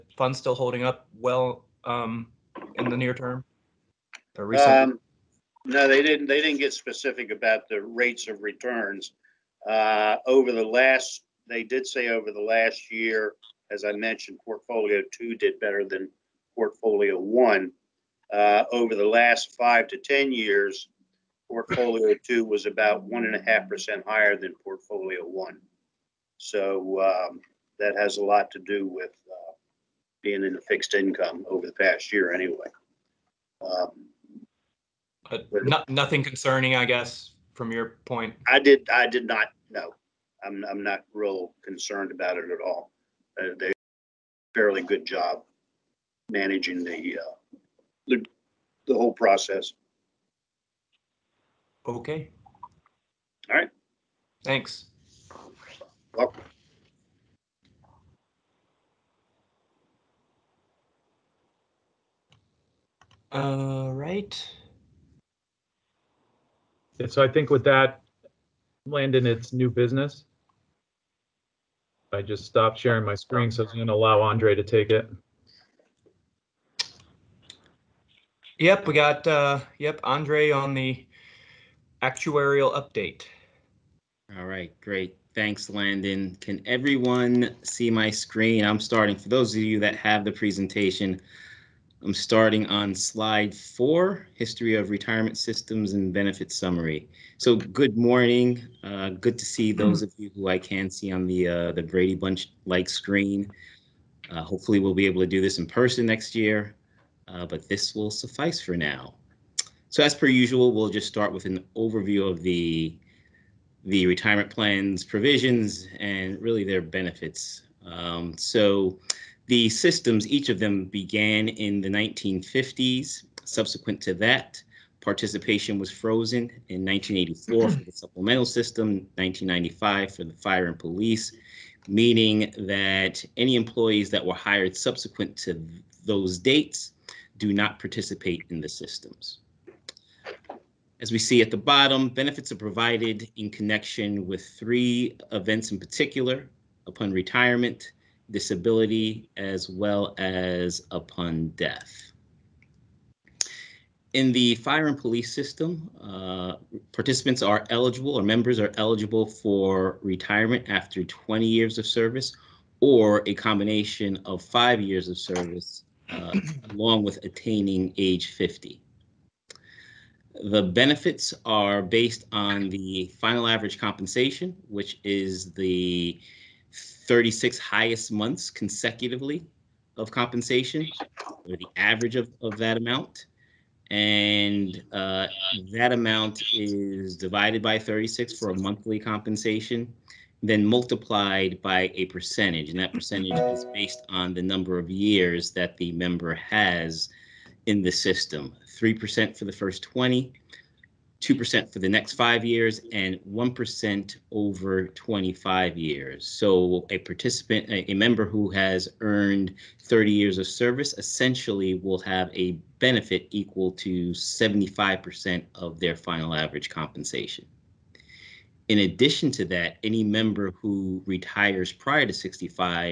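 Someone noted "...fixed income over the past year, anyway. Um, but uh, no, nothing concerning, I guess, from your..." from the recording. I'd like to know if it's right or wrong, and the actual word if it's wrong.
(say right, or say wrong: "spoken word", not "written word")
right.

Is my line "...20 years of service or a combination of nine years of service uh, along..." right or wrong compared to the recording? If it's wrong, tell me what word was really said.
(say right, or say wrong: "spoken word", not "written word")
wrong: "five", not "nine".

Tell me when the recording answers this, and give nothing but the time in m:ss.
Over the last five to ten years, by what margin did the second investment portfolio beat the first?
0:23.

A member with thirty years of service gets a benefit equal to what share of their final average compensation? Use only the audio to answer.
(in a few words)
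75%.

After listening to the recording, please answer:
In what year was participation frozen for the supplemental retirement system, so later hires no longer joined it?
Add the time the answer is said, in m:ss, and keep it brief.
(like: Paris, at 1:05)
1984, at 2:06.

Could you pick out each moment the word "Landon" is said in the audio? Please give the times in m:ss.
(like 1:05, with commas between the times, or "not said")
1:08, 1:25.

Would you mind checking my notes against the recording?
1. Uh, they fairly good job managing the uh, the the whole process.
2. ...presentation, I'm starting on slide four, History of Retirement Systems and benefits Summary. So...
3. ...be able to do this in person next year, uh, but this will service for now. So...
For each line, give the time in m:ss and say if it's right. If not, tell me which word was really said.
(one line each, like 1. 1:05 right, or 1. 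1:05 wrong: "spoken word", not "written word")
1. 0:43 right
2. 1:30 right
3. 1:44 wrong: "suffice", not "service".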